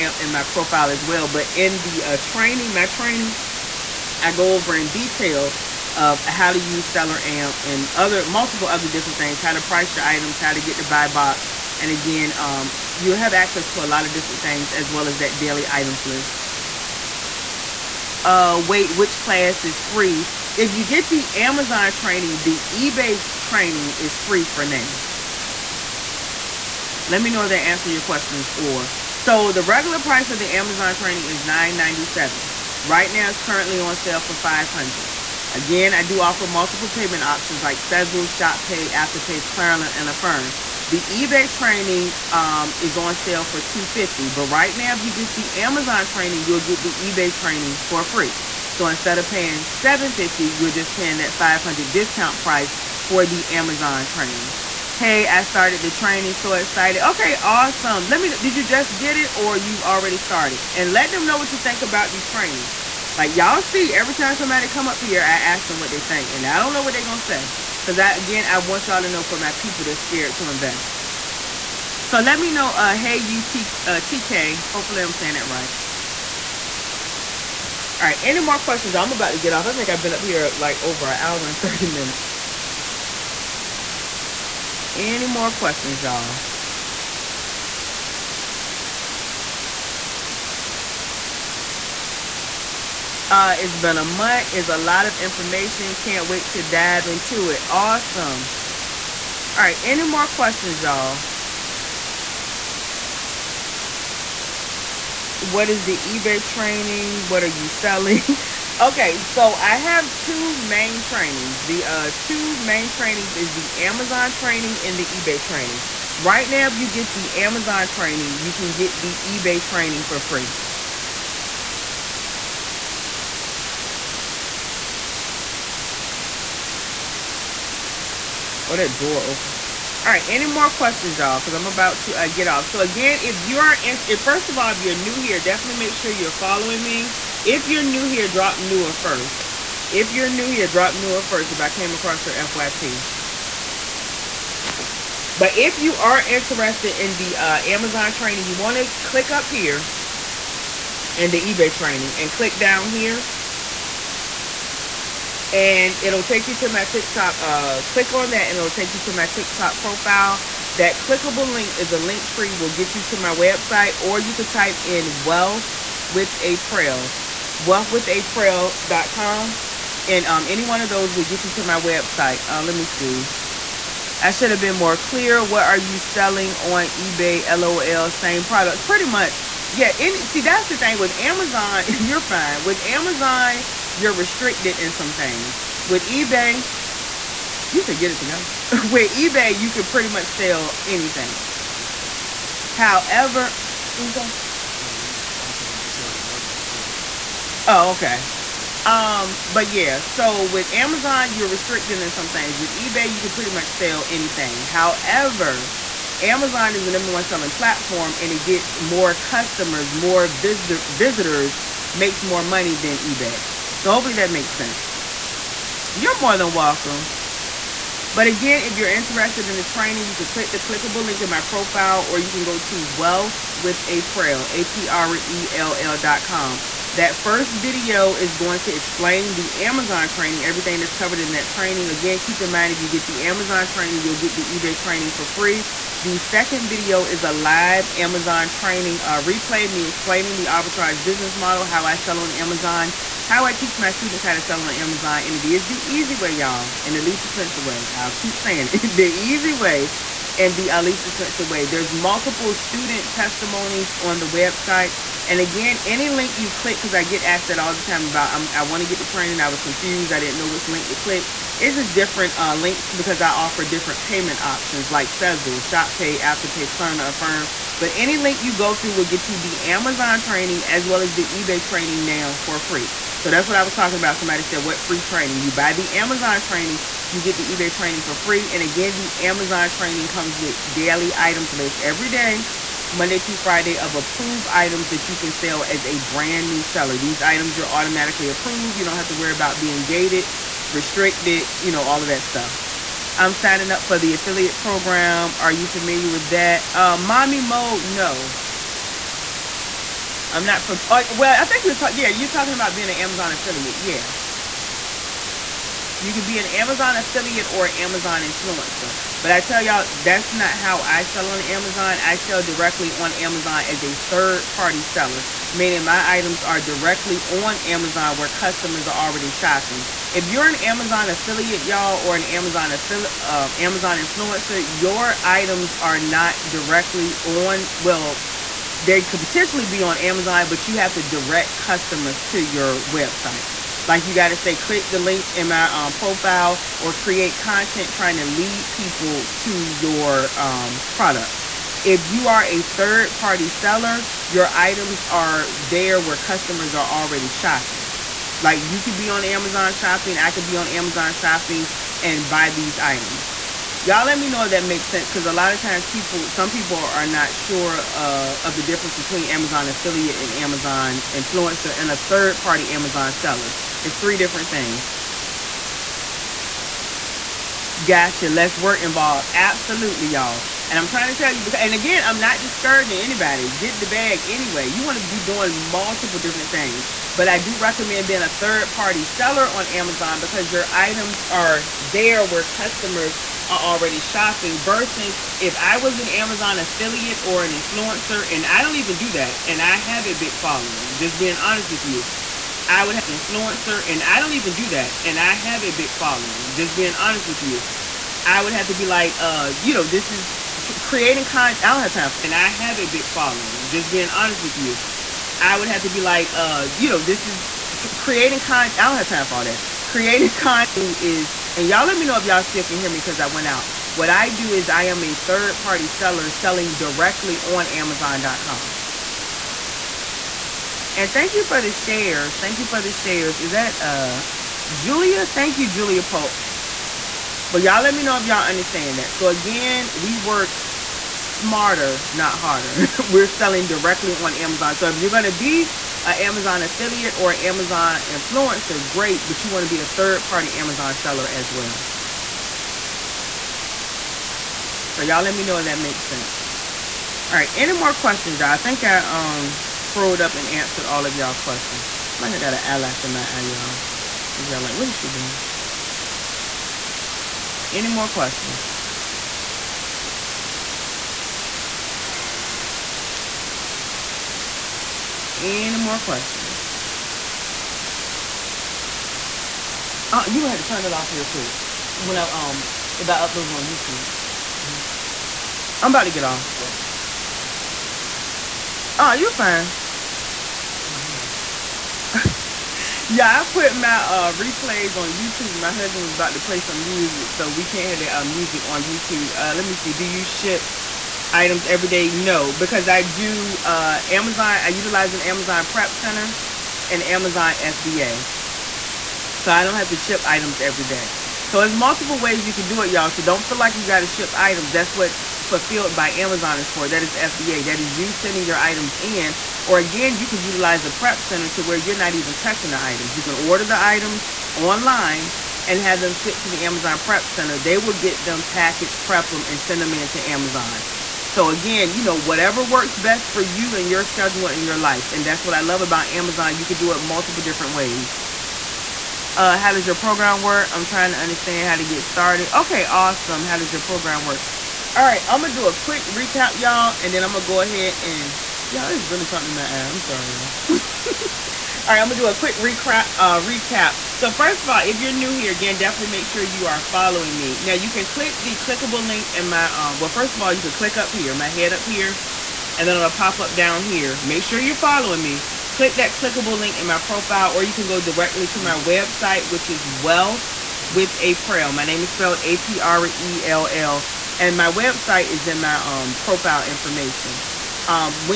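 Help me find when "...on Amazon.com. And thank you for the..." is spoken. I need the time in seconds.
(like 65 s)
417 s.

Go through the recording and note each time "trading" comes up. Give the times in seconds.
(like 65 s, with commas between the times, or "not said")
not said.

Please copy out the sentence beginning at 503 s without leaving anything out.
So don't feel like you got to ship items.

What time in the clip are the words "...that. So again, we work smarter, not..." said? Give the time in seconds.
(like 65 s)
428 s.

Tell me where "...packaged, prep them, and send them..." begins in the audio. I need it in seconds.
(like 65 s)
518 s.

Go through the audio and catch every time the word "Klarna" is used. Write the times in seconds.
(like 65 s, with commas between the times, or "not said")
39 s, 266 s.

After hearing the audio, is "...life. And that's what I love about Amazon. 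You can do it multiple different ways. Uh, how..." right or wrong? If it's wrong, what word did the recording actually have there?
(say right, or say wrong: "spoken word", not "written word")
right.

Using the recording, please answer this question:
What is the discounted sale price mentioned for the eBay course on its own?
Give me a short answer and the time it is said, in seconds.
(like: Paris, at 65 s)
$250, at 43 s.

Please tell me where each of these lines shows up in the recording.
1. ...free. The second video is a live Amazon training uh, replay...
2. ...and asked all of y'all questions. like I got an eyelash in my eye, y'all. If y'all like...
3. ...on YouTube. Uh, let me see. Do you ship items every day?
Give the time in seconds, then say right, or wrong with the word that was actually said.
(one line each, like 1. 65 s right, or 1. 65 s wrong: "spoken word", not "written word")
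1. 235 s right
2. 450 s wrong: "answered", not "asked"
3. 488 s right.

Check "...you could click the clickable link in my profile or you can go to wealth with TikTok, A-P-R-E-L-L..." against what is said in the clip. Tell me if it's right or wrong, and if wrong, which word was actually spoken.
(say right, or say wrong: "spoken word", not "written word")
wrong: "Aprell", not "TikTok".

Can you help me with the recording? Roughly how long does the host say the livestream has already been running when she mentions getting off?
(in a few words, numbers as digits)
over an hour and 30 minutes.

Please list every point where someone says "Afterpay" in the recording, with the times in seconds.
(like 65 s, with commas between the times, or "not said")
38 s, 266 s.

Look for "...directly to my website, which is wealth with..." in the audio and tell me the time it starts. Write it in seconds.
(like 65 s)
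558 s.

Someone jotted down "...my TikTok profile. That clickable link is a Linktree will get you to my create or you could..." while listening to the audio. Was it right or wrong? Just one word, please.
wrong.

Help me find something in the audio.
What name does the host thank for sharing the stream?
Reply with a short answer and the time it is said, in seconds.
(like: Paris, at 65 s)
Julia Pope, at 425 s.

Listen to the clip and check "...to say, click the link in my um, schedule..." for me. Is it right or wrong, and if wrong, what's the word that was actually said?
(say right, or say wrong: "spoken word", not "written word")
wrong: "profile", not "schedule".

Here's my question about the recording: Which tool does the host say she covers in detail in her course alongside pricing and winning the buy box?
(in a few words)
Seller Amp.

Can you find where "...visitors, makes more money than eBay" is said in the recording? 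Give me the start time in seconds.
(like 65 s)
210 s.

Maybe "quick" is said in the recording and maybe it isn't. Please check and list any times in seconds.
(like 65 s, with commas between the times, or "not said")
471 s, 535 s, 542 s.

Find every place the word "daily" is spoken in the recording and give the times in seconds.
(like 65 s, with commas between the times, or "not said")
15 s, 280 s.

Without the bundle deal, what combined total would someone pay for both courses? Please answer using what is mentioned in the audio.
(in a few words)
$750.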